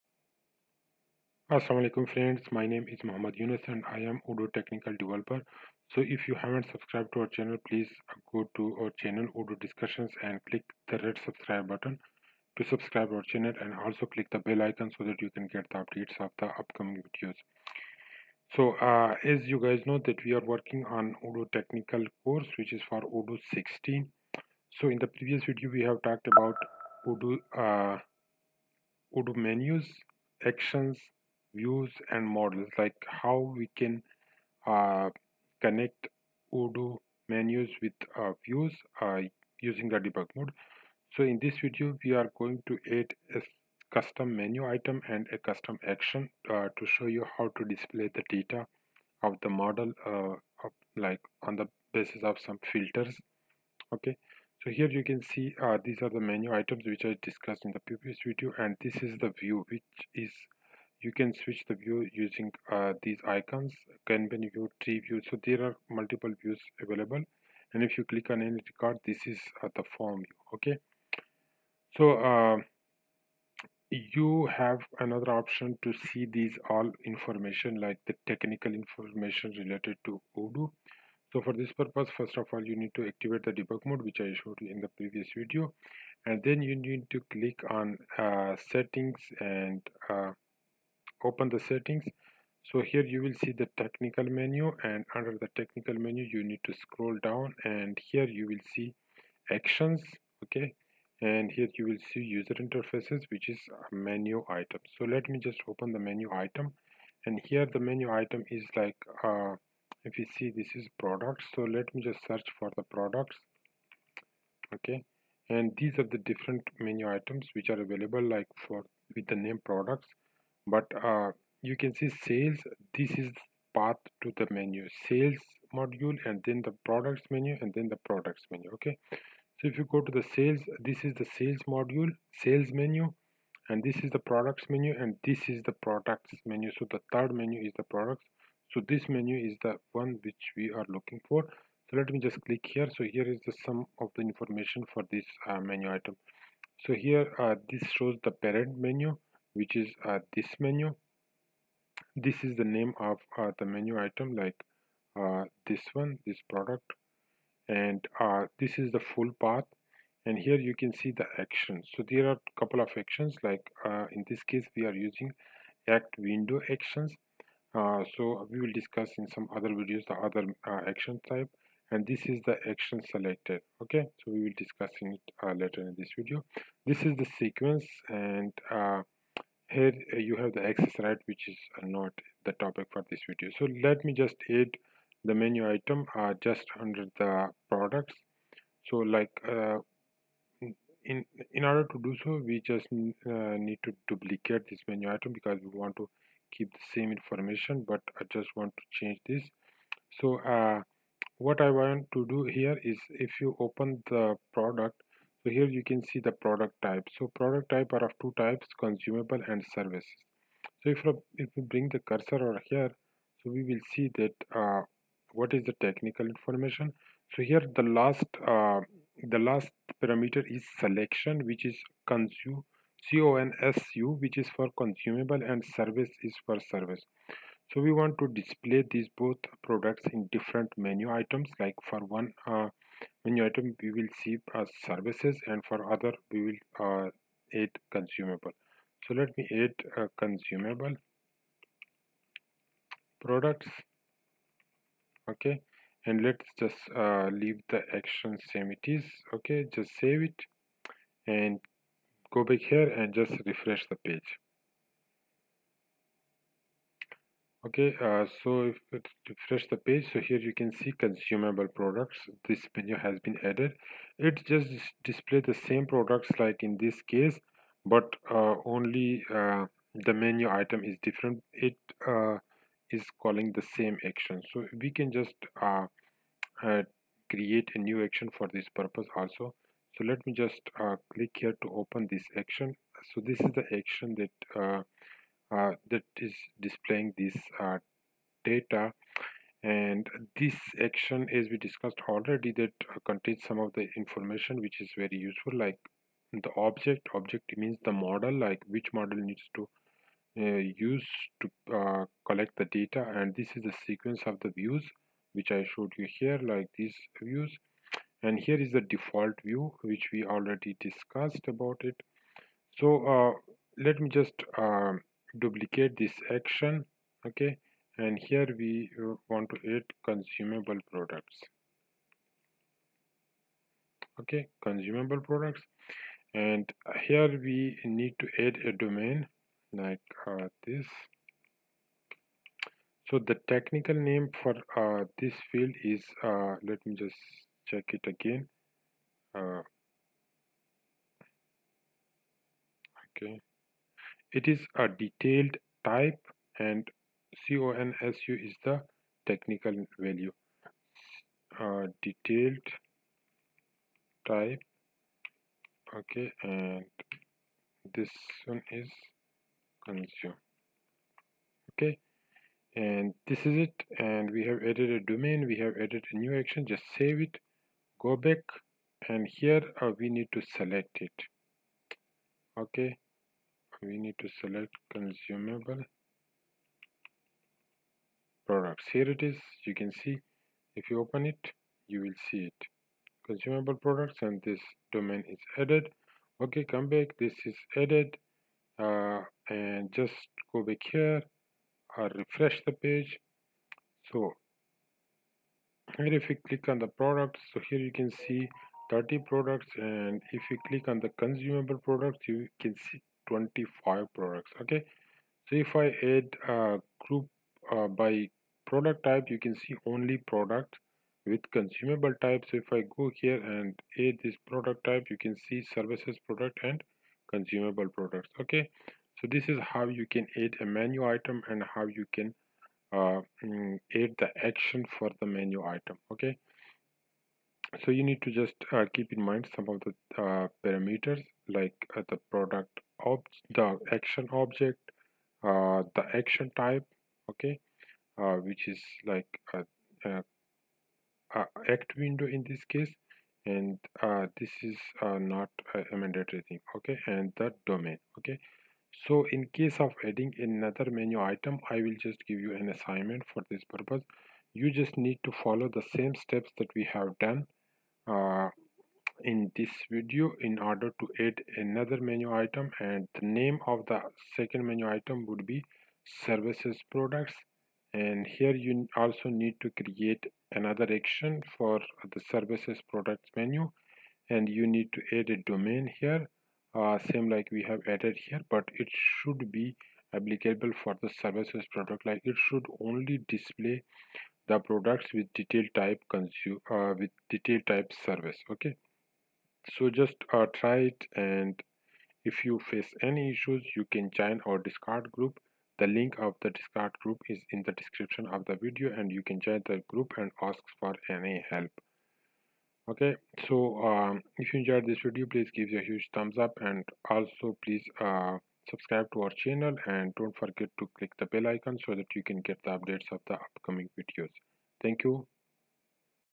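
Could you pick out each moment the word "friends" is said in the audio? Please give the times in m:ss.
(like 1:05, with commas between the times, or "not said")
0:02.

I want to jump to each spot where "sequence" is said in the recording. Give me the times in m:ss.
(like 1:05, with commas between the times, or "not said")
2:57, 5:03.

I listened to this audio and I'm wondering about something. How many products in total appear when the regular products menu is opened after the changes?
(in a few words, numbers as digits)
30.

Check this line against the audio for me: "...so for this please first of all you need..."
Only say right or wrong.
wrong.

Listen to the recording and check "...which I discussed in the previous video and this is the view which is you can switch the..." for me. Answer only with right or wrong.
right.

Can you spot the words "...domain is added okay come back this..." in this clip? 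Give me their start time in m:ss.
6:24.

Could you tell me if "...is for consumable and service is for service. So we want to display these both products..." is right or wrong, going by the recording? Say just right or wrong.
right.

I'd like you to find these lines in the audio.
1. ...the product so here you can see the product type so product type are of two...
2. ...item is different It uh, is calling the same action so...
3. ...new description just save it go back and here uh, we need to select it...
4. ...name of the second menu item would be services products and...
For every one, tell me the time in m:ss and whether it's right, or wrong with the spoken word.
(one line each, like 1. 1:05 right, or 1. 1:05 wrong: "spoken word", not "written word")
1. 3:24 right
2. 4:30 right
3. 6:06 wrong: "action", not "description"
4. 7:43 right.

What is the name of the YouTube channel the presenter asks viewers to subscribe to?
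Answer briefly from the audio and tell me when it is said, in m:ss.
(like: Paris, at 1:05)
Odoo Discussions, at 0:09.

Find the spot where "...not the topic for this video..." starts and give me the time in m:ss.
3:01.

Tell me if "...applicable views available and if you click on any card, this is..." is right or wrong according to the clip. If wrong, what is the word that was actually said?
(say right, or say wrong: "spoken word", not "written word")
wrong: "multiple", not "applicable".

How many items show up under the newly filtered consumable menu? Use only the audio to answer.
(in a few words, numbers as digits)
25.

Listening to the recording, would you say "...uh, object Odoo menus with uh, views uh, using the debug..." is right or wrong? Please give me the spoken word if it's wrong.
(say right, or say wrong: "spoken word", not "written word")
wrong: "connect", not "object".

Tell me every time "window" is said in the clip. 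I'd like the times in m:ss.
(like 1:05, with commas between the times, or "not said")
2:46, 7:21.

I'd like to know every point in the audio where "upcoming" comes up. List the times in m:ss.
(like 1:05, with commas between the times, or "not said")
0:16, 8:33.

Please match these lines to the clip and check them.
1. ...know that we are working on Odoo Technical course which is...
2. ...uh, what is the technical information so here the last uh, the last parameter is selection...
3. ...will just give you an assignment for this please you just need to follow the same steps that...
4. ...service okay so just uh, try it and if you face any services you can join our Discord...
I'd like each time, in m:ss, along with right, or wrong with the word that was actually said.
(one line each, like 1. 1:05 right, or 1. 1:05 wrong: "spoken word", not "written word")
1. 0:19 right
2. 3:34 right
3. 7:31 wrong: "purpose", not "please"
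4. 8:08 wrong: "issues", not "services".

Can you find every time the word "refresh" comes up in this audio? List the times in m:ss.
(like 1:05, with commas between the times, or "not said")
4:13, 4:19, 6:32.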